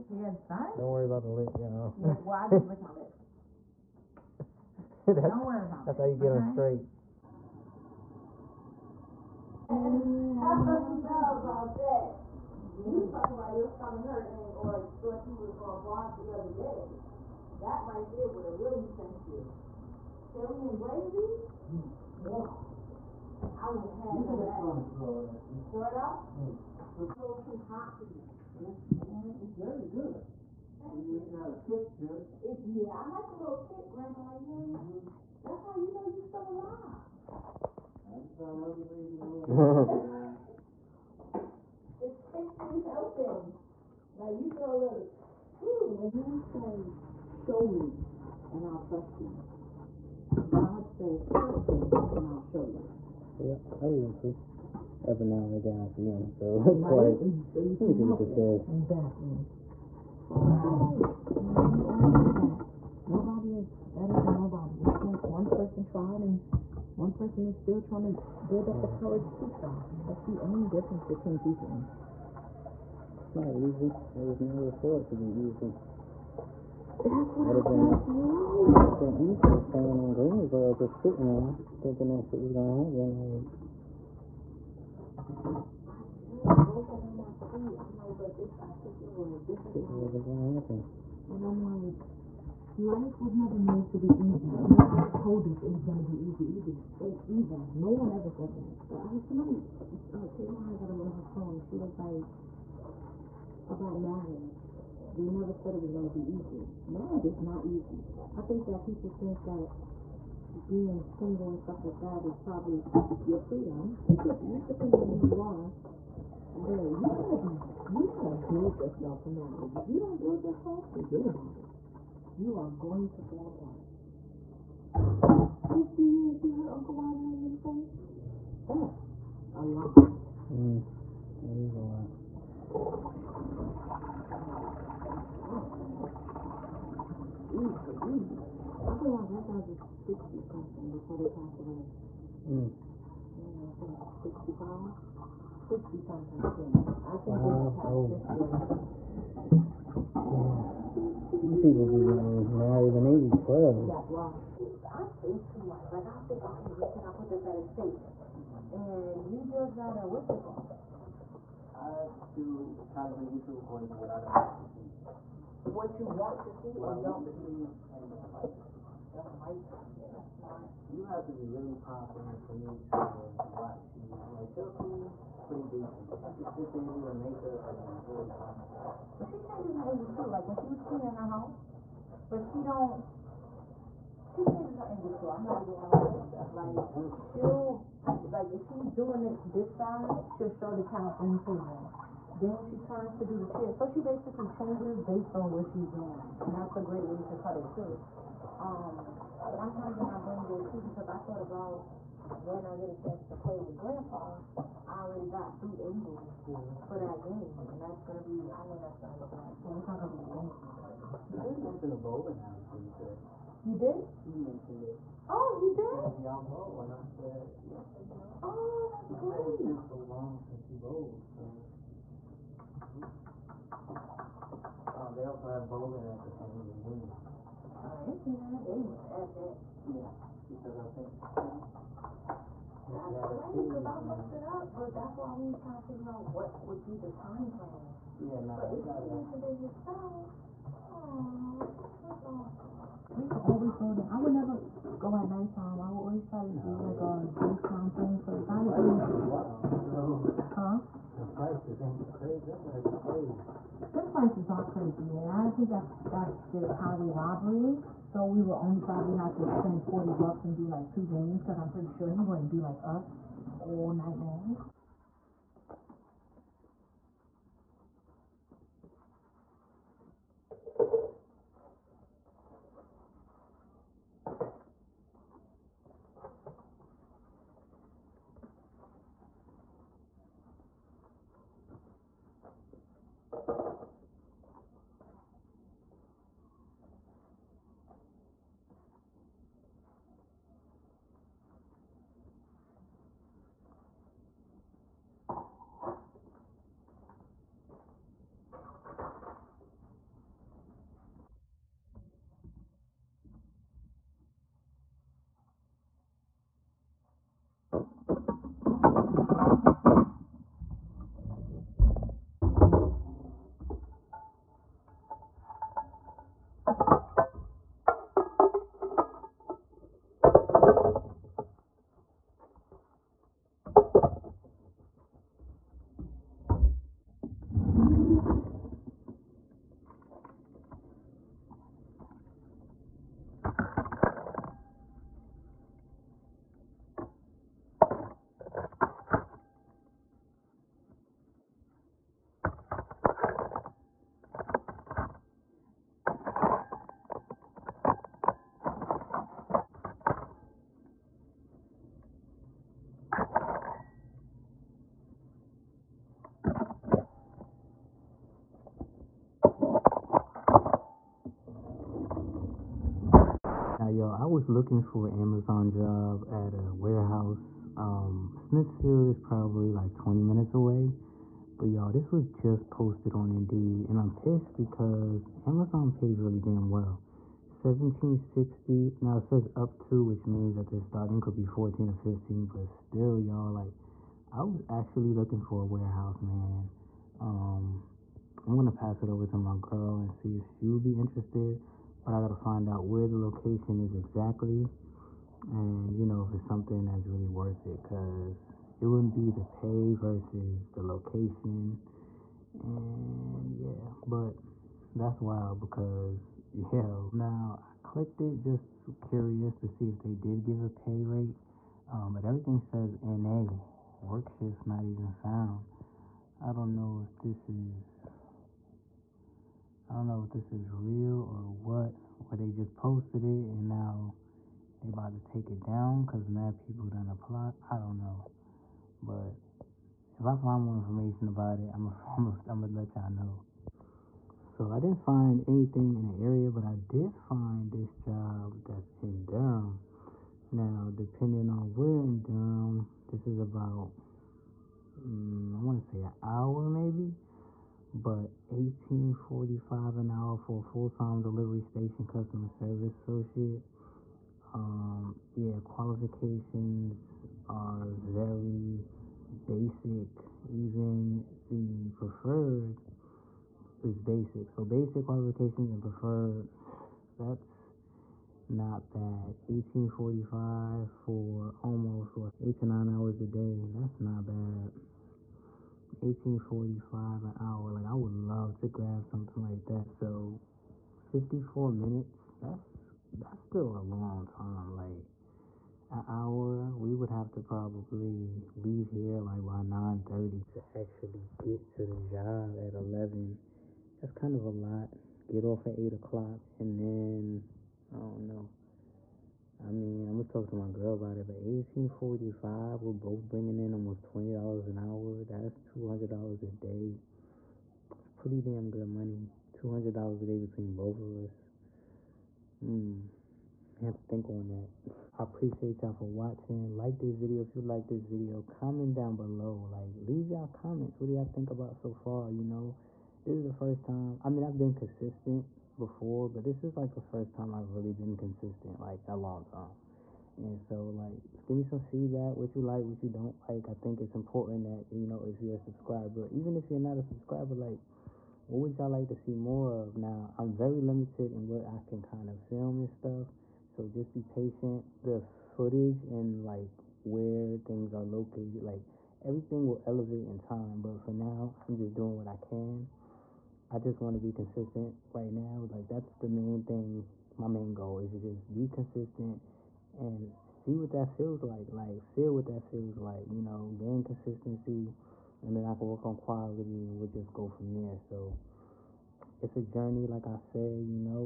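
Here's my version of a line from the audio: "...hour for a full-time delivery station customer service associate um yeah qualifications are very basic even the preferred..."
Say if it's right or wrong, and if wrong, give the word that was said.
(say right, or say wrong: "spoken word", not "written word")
right.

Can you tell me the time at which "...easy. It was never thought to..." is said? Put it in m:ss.
1:13.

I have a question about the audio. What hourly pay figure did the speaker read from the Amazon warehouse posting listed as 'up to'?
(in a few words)
17.60.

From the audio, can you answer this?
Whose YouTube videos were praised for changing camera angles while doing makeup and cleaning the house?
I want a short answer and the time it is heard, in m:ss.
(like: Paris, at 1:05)
Chelsea, at 2:54.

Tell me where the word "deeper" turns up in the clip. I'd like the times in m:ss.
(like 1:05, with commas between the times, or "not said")
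not said.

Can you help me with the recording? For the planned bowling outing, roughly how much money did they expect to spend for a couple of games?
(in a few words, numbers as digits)
40 bucks.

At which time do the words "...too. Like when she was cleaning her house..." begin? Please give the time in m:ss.
3:00.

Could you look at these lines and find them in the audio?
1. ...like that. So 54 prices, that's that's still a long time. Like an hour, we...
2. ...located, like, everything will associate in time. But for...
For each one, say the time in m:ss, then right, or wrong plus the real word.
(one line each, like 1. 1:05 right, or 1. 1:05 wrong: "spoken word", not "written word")
1. 7:59 wrong: "minutes", not "prices"
2. 9:08 wrong: "elevate", not "associate".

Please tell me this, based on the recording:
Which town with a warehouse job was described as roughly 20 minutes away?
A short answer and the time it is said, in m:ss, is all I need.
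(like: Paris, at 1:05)
Smithfield, at 6:08.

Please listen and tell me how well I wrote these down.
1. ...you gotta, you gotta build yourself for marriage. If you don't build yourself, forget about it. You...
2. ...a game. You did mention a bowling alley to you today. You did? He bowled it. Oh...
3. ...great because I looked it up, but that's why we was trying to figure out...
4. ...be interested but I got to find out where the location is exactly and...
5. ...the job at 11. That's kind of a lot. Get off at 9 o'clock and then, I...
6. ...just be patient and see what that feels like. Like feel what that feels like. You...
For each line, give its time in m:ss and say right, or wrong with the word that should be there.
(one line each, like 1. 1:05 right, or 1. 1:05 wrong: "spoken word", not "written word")
1. 1:56 right
2. 3:30 wrong: "mentioned", not "bowled"
3. 3:53 right
4. 6:30 right
5. 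8:11 wrong: "8", not "9"
6. 9:18 wrong: "consistent", not "patient".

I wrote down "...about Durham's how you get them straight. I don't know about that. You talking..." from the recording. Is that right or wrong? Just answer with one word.
wrong.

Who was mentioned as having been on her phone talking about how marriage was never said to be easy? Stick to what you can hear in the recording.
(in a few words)
Taylor.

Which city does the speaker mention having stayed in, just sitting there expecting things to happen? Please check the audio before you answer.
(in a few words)
Greensboro.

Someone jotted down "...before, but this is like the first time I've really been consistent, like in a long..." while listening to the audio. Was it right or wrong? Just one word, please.
right.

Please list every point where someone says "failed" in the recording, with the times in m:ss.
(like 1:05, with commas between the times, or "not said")
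not said.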